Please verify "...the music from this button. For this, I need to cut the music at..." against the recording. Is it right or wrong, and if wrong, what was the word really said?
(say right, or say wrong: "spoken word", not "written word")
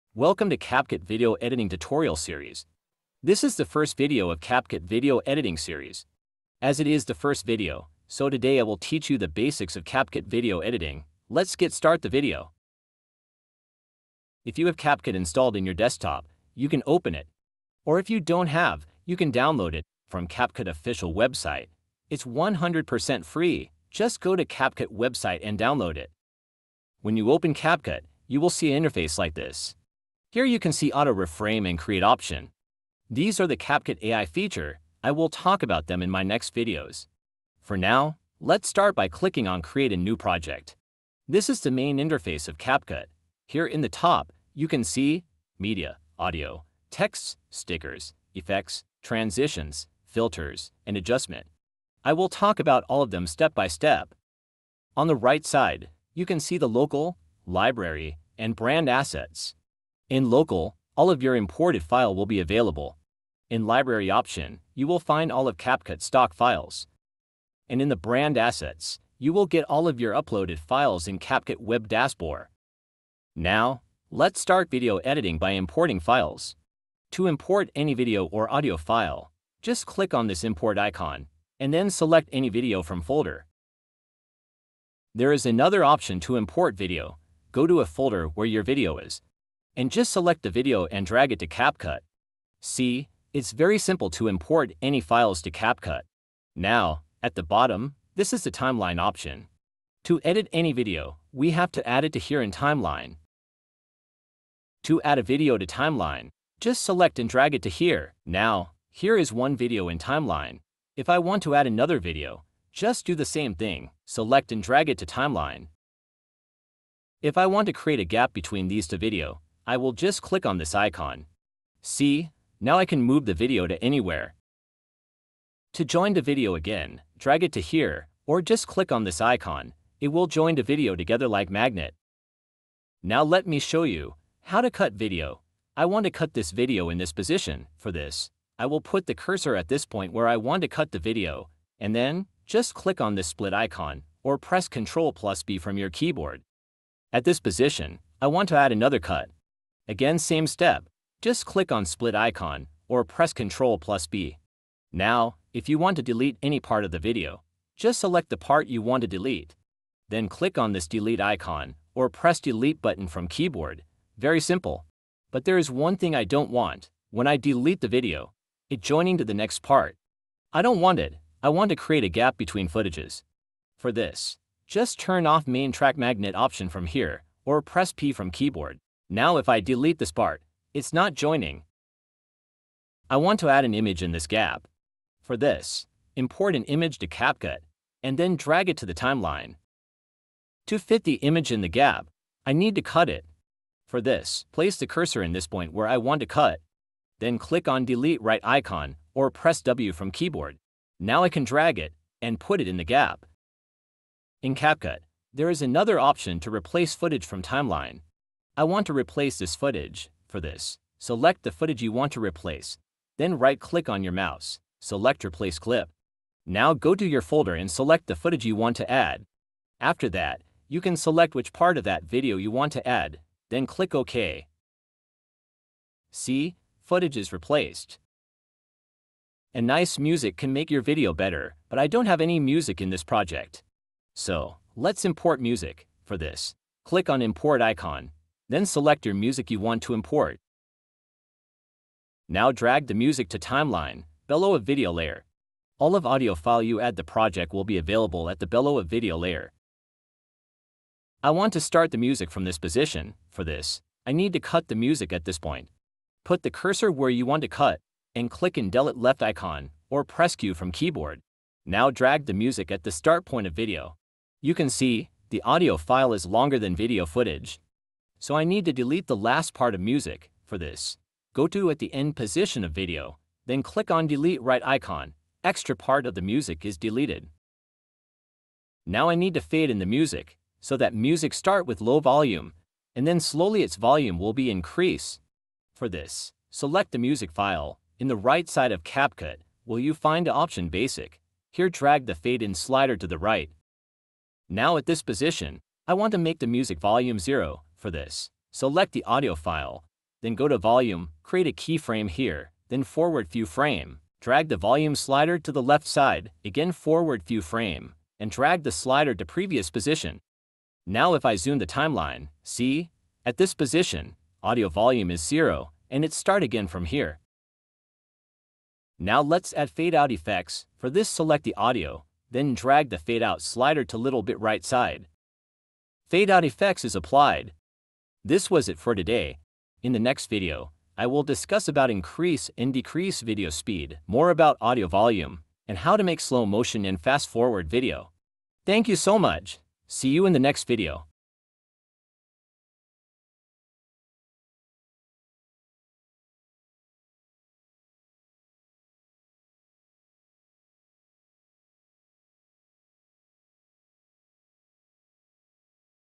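wrong: "position", not "button".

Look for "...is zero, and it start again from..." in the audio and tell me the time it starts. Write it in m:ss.
5:15.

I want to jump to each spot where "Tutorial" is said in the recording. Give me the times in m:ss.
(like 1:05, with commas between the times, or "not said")
0:01.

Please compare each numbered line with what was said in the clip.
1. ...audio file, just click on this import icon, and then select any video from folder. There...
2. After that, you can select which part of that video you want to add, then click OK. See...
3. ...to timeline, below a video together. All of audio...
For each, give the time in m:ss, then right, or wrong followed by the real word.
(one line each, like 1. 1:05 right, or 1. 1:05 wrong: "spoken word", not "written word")
1. 1:18 right
2. 3:39 right
3. 4:03 wrong: "layer", not "together".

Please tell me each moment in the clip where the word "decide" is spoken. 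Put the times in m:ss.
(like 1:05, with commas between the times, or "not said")
not said.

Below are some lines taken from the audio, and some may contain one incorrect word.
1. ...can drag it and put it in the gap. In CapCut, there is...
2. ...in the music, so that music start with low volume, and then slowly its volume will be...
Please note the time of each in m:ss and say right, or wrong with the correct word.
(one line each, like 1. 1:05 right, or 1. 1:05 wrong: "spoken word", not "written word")
1. 3:21 right
2. 4:39 right.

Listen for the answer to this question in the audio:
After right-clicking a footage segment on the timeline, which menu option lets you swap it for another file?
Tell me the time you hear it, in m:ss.
3:35.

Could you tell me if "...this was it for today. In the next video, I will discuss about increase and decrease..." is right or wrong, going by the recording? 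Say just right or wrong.
right.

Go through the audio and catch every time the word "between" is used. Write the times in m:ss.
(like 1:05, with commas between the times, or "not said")
1:58, 2:52.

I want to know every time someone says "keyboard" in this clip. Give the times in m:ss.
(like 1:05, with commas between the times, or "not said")
2:25, 2:43, 2:58, 3:20, 4:20.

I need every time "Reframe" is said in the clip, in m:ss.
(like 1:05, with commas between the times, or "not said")
0:31.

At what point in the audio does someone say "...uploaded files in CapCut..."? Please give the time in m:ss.
1:10.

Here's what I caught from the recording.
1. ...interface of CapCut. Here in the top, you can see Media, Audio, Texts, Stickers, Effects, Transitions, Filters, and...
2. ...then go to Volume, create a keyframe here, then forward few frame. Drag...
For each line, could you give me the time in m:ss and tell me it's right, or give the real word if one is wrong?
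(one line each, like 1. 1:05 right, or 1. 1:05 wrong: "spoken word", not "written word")
1. 0:41 right
2. 5:00 right.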